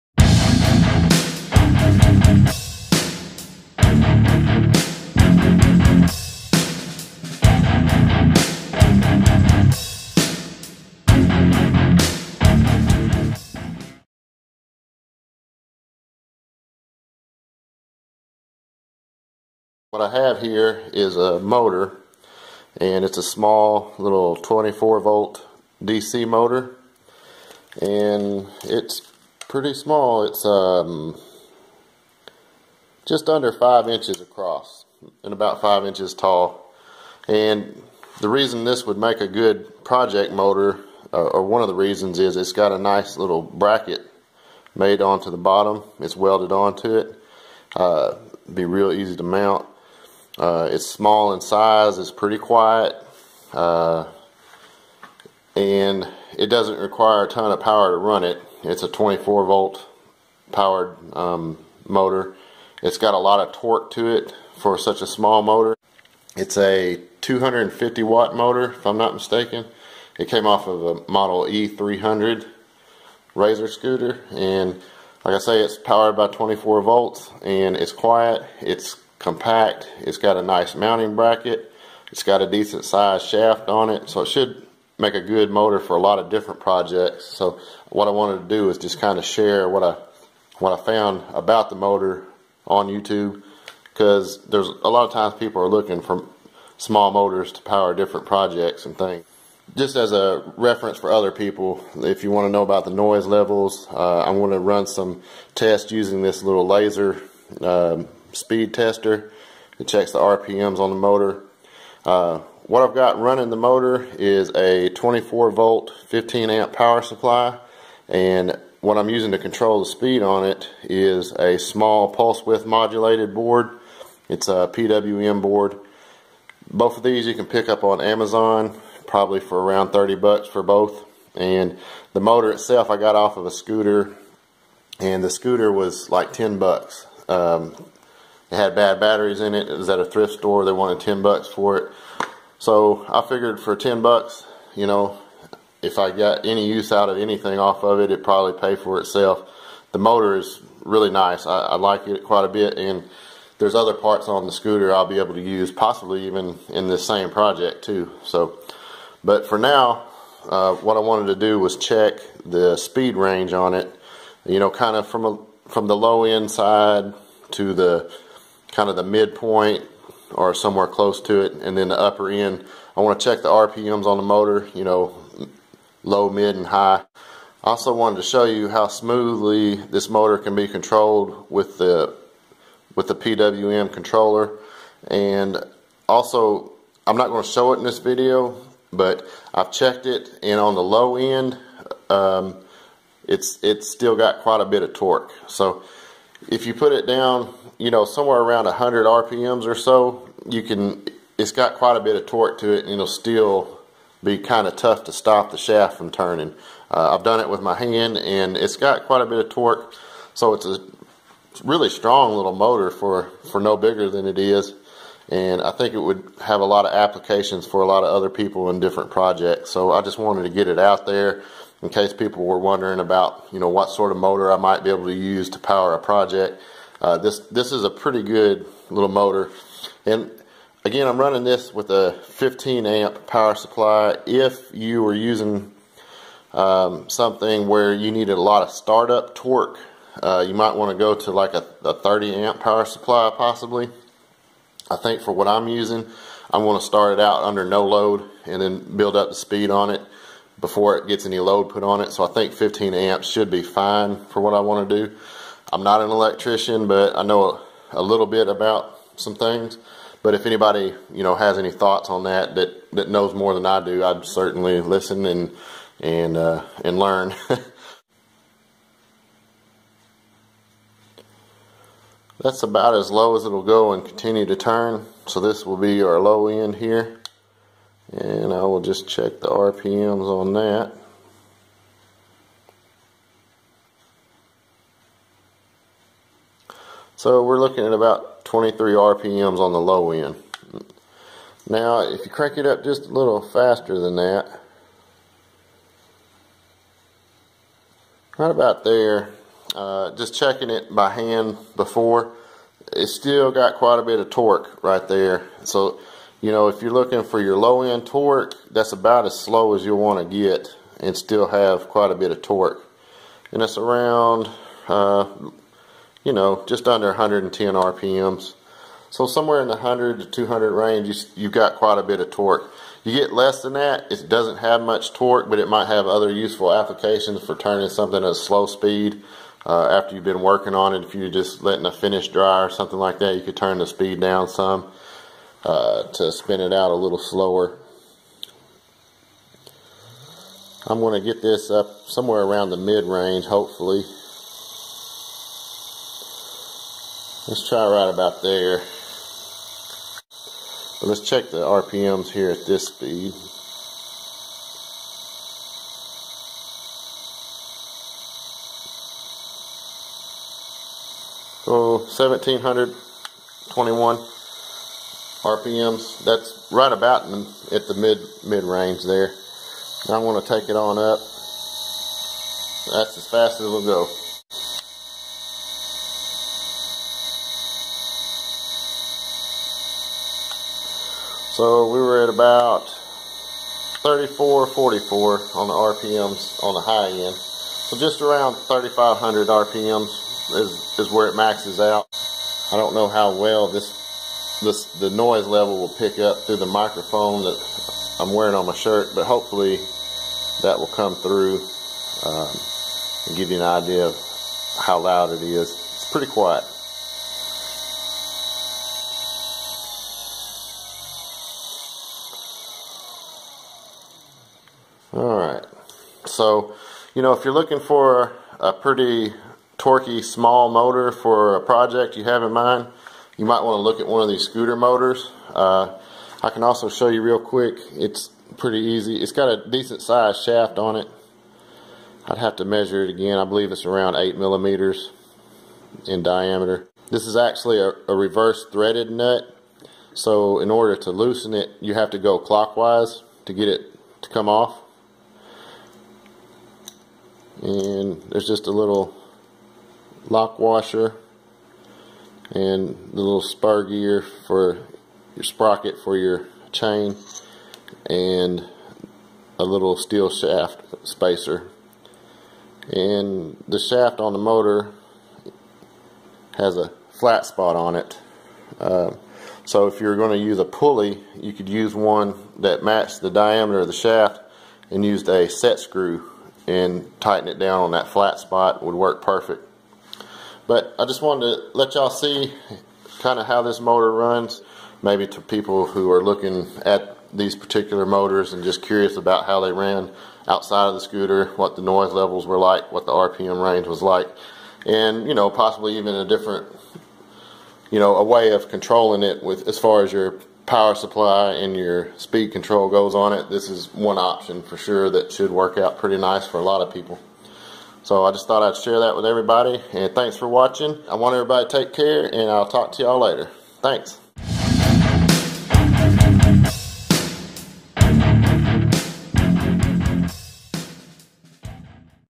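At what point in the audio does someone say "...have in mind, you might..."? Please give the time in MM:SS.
07:02.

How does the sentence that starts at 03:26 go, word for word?
Uh, I've done it with my hand and it's got quite a bit of torque.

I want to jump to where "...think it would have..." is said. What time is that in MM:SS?
03:35.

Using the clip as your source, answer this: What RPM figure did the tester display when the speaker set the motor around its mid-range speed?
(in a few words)
1721.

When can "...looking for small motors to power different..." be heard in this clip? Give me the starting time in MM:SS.
01:35.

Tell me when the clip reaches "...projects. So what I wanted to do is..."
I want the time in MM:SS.
01:26.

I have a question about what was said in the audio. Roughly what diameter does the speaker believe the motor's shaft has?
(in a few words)
8 millimeters.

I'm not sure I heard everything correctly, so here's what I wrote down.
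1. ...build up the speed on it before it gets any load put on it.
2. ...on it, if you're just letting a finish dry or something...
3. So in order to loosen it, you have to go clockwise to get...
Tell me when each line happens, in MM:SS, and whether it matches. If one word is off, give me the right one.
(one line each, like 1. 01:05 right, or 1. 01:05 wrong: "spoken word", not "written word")
1. 04:08 right
2. 05:30 right
3. 07:20 right.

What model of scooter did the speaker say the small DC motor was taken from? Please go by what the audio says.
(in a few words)
E300.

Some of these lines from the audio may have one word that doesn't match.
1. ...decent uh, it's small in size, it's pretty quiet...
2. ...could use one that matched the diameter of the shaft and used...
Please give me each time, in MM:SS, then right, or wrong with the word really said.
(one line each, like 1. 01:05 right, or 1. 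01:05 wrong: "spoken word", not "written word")
1. 00:49 wrong: "mount", not "decent"
2. 07:51 right.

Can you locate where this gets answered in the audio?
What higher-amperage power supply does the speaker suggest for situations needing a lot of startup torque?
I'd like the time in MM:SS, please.
04:01.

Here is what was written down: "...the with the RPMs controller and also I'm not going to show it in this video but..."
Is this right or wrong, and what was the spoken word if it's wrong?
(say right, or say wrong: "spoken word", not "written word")
wrong: "PWM", not "RPMs".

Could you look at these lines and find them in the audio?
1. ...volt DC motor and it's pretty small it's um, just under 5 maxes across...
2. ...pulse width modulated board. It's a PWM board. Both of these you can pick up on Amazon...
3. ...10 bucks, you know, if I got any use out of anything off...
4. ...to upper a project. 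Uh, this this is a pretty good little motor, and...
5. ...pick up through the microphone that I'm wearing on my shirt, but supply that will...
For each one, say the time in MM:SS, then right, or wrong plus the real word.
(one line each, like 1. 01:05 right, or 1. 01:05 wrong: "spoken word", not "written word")
1. 00:25 wrong: "inches", not "maxes"
2. 02:02 right
3. 02:23 right
4. 03:45 wrong: "power", not "upper"
5. 06:35 wrong: "hopefully", not "supply".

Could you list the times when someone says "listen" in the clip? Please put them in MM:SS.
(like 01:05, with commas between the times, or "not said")
04:24.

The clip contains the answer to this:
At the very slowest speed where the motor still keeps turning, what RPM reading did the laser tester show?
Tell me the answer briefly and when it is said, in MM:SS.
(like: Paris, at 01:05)
23, at 04:48.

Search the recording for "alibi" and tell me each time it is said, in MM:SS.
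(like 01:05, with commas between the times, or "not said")
not said.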